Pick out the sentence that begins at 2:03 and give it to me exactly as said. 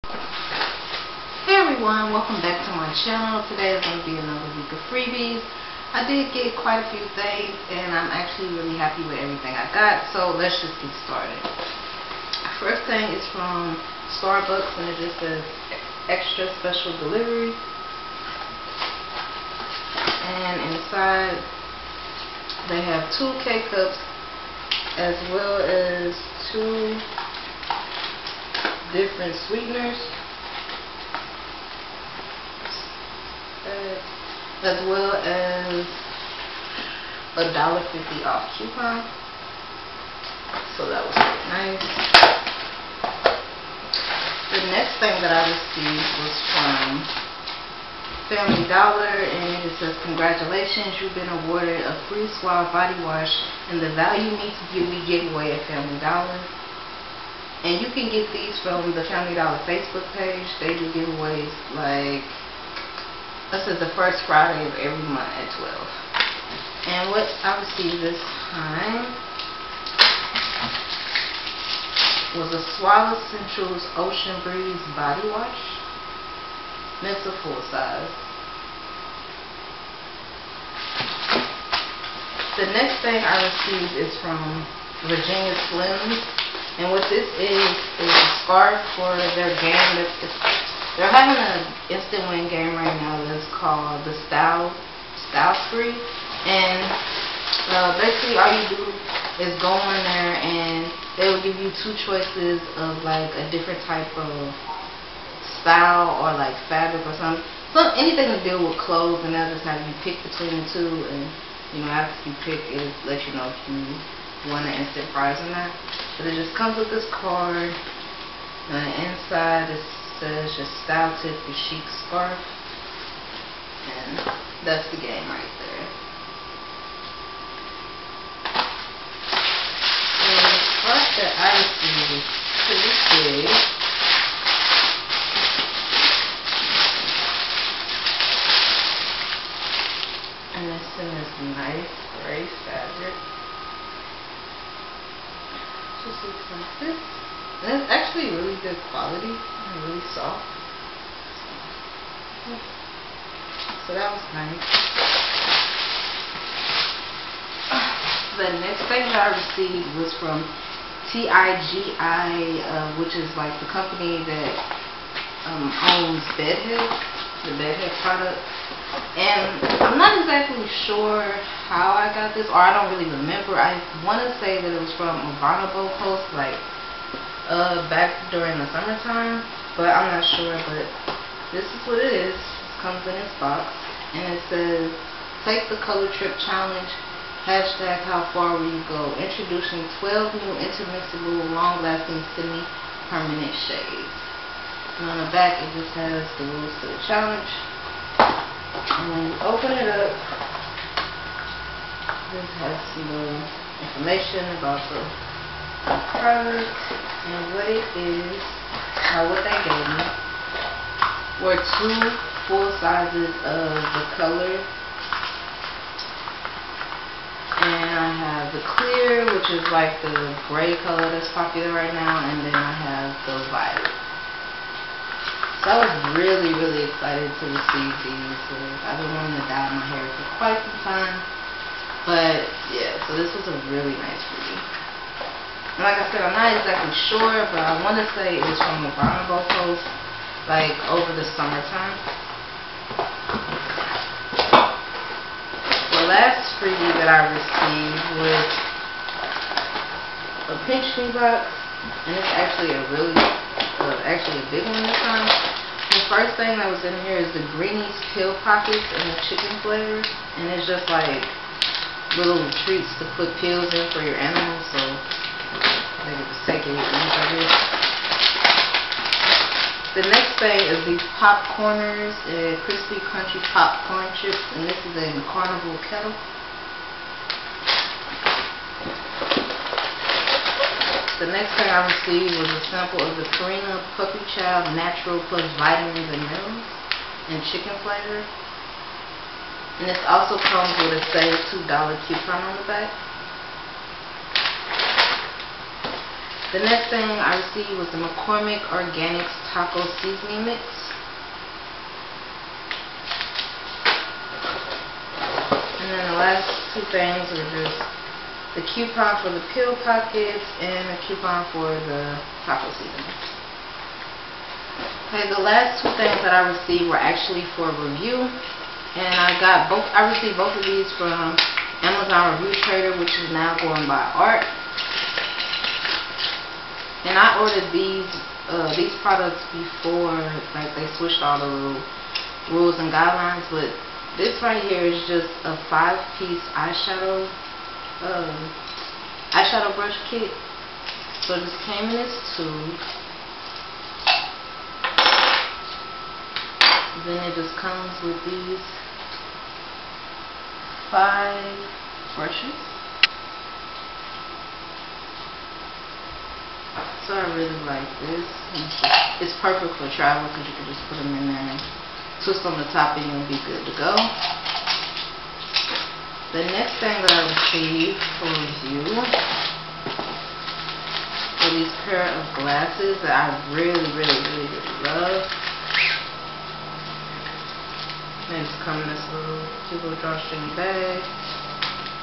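And that's the game right there.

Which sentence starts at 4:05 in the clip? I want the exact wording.
The last freebie that I received was a pink box, and it's actually a really, uh, actually a big one this time.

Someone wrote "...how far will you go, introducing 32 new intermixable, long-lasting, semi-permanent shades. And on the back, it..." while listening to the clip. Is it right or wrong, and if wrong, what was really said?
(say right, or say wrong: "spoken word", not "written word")
wrong: "12", not "32".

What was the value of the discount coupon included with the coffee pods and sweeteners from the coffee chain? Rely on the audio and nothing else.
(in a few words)
$1.50 off.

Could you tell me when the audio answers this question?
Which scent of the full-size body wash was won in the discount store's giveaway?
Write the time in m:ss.
1:13.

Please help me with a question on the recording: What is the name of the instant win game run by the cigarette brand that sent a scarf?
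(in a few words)
Style Spree.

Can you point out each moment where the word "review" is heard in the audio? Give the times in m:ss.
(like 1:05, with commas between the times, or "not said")
5:17, 5:22.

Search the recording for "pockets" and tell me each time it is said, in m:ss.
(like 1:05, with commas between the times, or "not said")
4:18, 5:09.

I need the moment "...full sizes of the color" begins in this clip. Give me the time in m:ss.
3:32.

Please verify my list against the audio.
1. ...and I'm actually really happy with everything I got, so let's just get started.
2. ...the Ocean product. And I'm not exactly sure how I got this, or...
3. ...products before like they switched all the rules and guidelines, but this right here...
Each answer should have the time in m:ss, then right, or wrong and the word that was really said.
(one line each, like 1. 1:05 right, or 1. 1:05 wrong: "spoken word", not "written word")
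1. 0:07 right
2. 2:47 wrong: "Bedhead", not "Ocean"
3. 5:29 right.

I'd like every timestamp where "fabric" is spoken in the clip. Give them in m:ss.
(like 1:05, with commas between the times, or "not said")
1:46, 2:22.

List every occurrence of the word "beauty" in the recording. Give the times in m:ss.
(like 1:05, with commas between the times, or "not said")
0:54.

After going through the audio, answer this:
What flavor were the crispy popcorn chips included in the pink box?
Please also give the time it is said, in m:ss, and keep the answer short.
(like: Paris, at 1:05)
Carnival Kettle, at 4:35.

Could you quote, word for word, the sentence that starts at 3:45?
So I was really, really excited to receive these.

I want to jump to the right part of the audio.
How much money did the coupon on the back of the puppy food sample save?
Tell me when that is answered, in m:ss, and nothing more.
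4:51.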